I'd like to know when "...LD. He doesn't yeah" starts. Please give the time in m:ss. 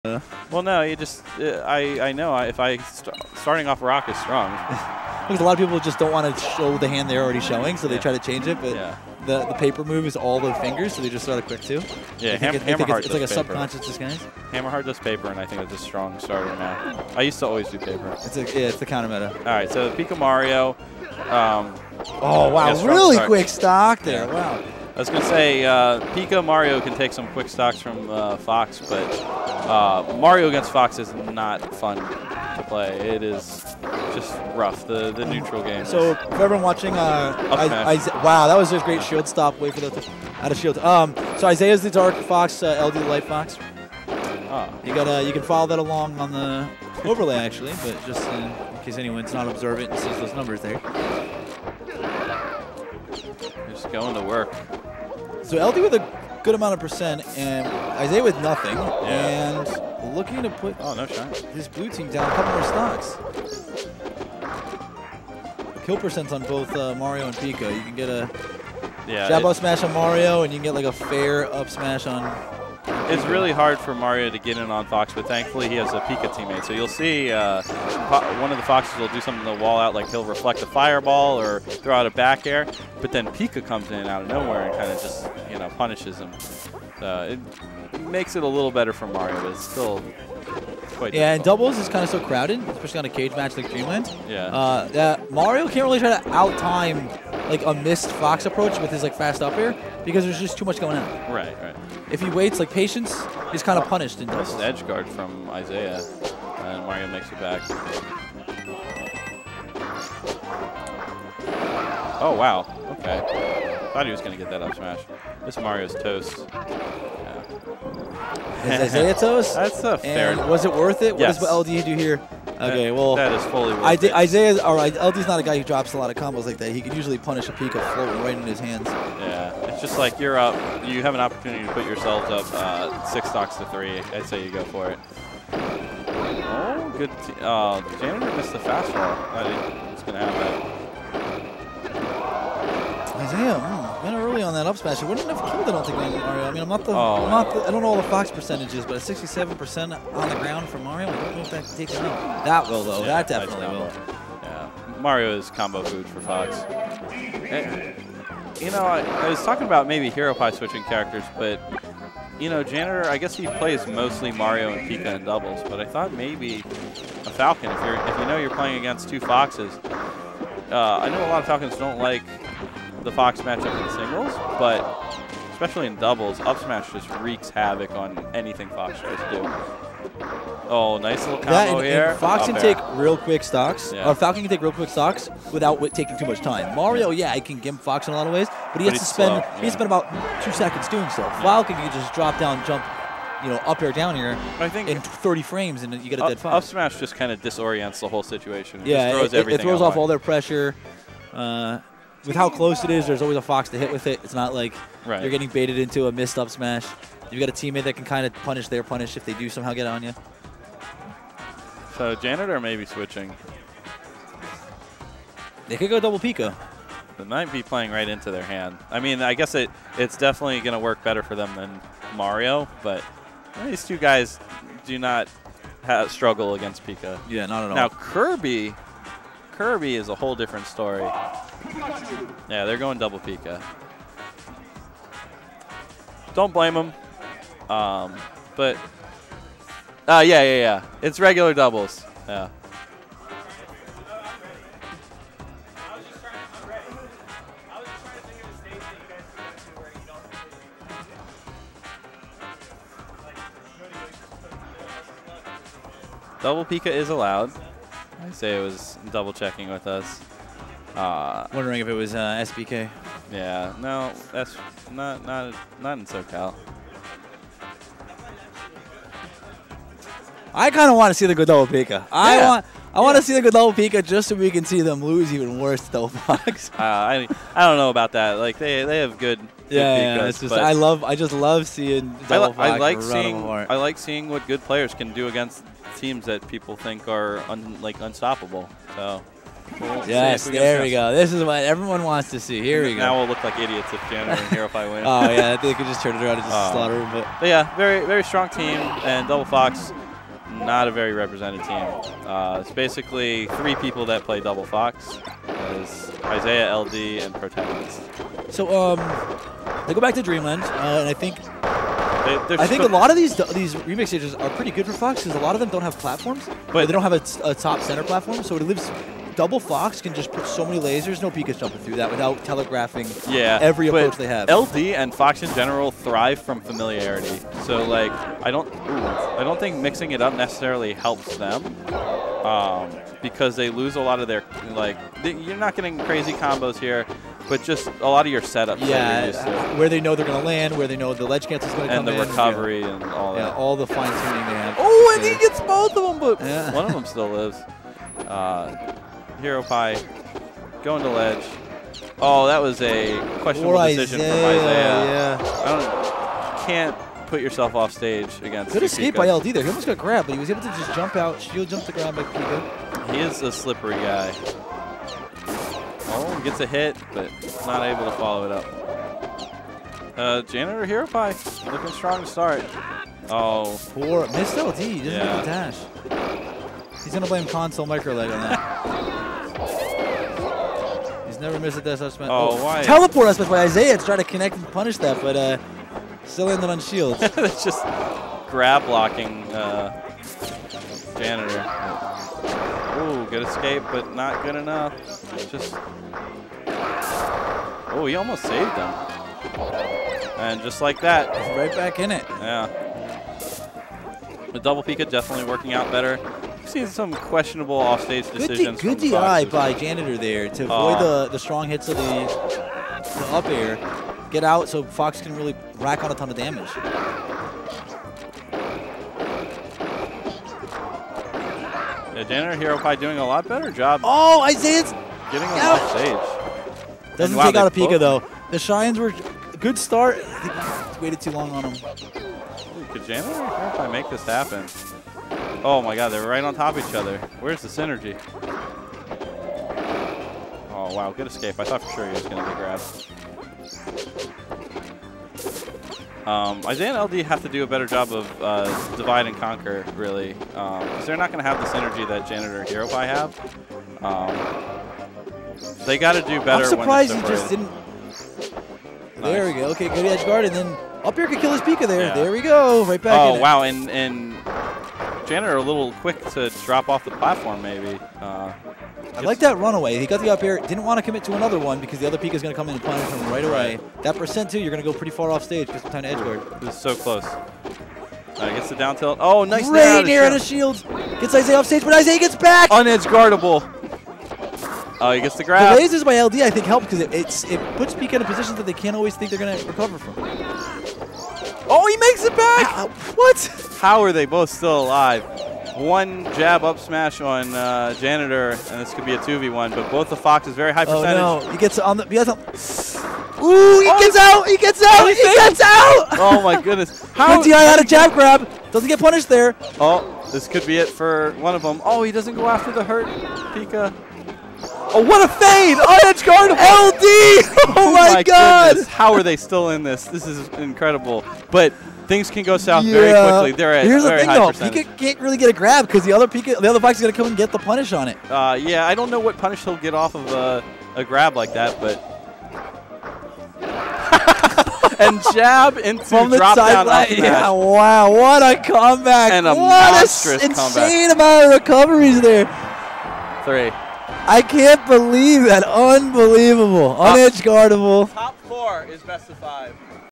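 6:14.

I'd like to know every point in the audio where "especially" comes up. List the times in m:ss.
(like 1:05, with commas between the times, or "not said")
1:32, 2:55.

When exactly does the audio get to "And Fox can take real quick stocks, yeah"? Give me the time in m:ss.
3:02.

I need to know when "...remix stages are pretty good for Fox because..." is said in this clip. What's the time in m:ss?
5:13.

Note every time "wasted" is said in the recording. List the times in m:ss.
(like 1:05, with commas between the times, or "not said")
not said.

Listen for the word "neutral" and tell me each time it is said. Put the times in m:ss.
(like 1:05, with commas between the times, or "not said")
0:35.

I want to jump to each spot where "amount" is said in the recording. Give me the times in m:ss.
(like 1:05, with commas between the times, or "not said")
0:56, 9:01.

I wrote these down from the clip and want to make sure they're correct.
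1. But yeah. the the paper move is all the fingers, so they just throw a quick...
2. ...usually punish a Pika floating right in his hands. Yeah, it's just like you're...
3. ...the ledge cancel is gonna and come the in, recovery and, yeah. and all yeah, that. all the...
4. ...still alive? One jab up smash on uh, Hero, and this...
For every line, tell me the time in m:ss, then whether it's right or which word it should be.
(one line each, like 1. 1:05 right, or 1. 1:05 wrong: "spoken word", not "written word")
1. 0:08 right
2. 2:06 right
3. 5:41 right
4. 8:14 wrong: "Janitor", not "Hero".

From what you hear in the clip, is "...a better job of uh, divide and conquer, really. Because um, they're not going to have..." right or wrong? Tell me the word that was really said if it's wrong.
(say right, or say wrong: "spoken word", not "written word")
right.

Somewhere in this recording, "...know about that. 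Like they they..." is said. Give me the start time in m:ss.
4:37.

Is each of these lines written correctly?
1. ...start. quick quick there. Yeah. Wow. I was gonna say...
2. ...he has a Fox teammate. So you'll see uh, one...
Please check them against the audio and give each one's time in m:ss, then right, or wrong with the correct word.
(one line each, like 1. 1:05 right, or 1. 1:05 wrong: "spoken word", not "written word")
1. 0:23 wrong: "stock", not "quick"
2. 1:15 wrong: "Pika", not "Fox".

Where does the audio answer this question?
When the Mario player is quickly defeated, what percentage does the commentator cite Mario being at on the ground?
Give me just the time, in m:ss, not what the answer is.
2:28.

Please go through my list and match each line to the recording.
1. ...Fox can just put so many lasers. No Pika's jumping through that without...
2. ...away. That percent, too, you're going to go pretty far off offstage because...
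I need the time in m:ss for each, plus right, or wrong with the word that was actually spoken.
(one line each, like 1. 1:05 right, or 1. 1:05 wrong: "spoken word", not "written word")
1. 5:19 right
2. 7:53 wrong: "stage", not "offstage".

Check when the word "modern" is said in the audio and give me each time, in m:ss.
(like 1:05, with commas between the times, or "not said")
not said.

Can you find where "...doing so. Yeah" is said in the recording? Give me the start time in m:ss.
3:10.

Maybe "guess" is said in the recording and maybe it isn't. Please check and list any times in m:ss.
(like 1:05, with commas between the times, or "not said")
2:43, 3:39.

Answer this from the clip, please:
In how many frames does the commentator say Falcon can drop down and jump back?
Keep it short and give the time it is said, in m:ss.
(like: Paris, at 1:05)
30, at 3:15.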